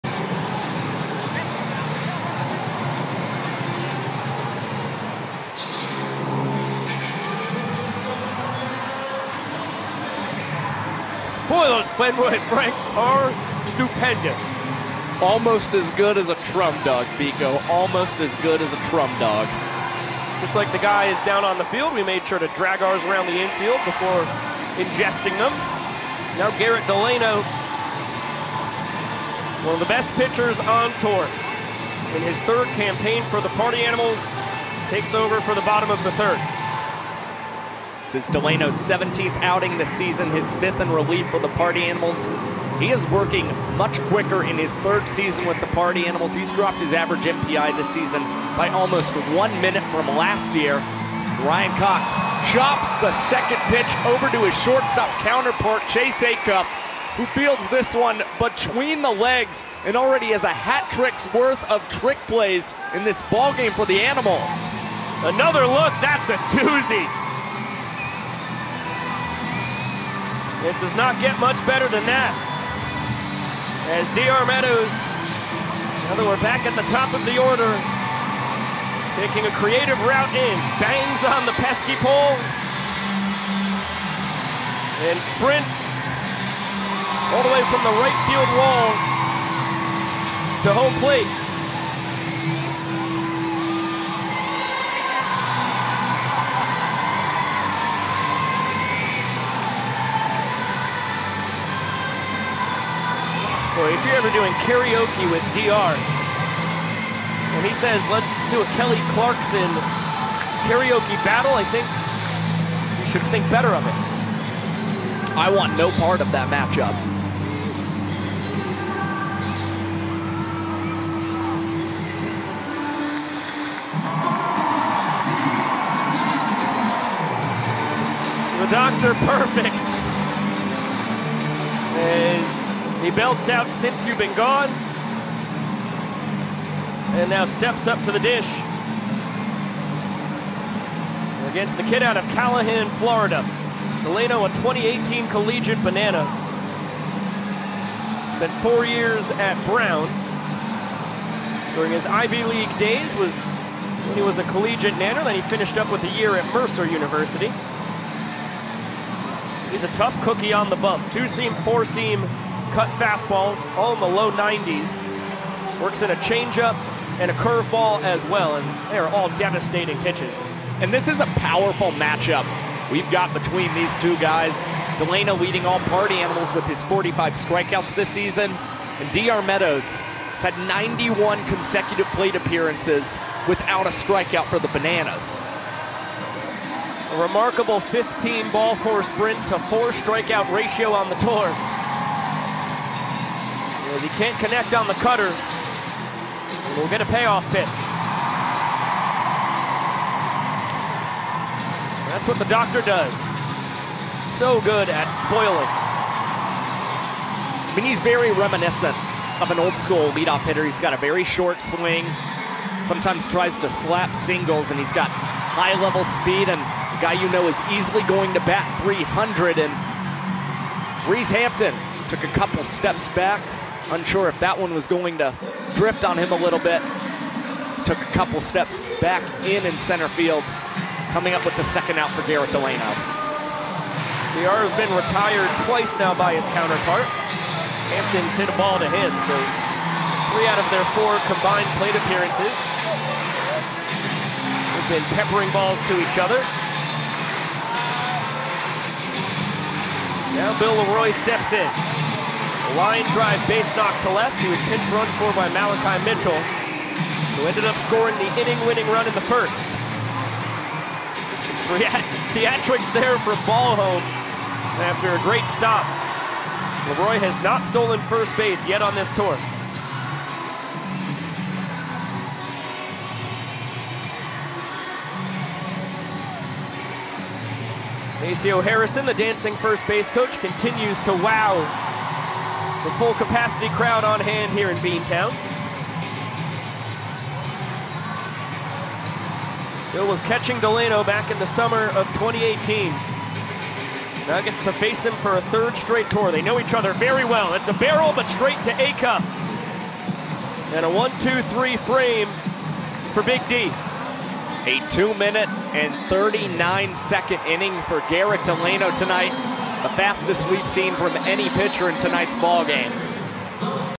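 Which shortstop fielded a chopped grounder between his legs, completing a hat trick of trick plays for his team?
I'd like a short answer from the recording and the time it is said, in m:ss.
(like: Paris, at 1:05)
Chase Acup, at 0:55.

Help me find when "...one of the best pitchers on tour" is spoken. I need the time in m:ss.
0:29.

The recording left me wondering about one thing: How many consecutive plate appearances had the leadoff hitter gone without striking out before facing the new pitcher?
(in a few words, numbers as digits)
91.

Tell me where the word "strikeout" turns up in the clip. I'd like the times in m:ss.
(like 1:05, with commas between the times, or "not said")
2:57, 3:03, 3:09.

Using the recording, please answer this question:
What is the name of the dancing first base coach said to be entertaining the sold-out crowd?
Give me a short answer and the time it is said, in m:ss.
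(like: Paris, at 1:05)
Maceo Harrison, at 4:38.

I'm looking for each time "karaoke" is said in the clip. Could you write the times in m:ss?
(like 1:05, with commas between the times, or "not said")
1:44, 1:50.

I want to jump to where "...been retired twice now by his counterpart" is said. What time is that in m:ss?
3:54.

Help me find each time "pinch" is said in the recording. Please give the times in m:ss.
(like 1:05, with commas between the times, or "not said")
4:14.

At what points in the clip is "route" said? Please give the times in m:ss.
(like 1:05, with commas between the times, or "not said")
1:20.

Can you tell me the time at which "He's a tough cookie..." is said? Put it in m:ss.
2:39.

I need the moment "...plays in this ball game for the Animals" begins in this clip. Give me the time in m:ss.
1:02.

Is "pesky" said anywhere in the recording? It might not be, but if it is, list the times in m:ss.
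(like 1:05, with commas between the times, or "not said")
1:21.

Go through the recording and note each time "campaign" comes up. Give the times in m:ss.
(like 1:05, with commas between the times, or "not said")
0:32.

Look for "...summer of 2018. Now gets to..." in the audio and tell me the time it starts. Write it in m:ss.
4:51.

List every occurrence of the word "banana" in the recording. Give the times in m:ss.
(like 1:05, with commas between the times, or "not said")
2:25, 3:04.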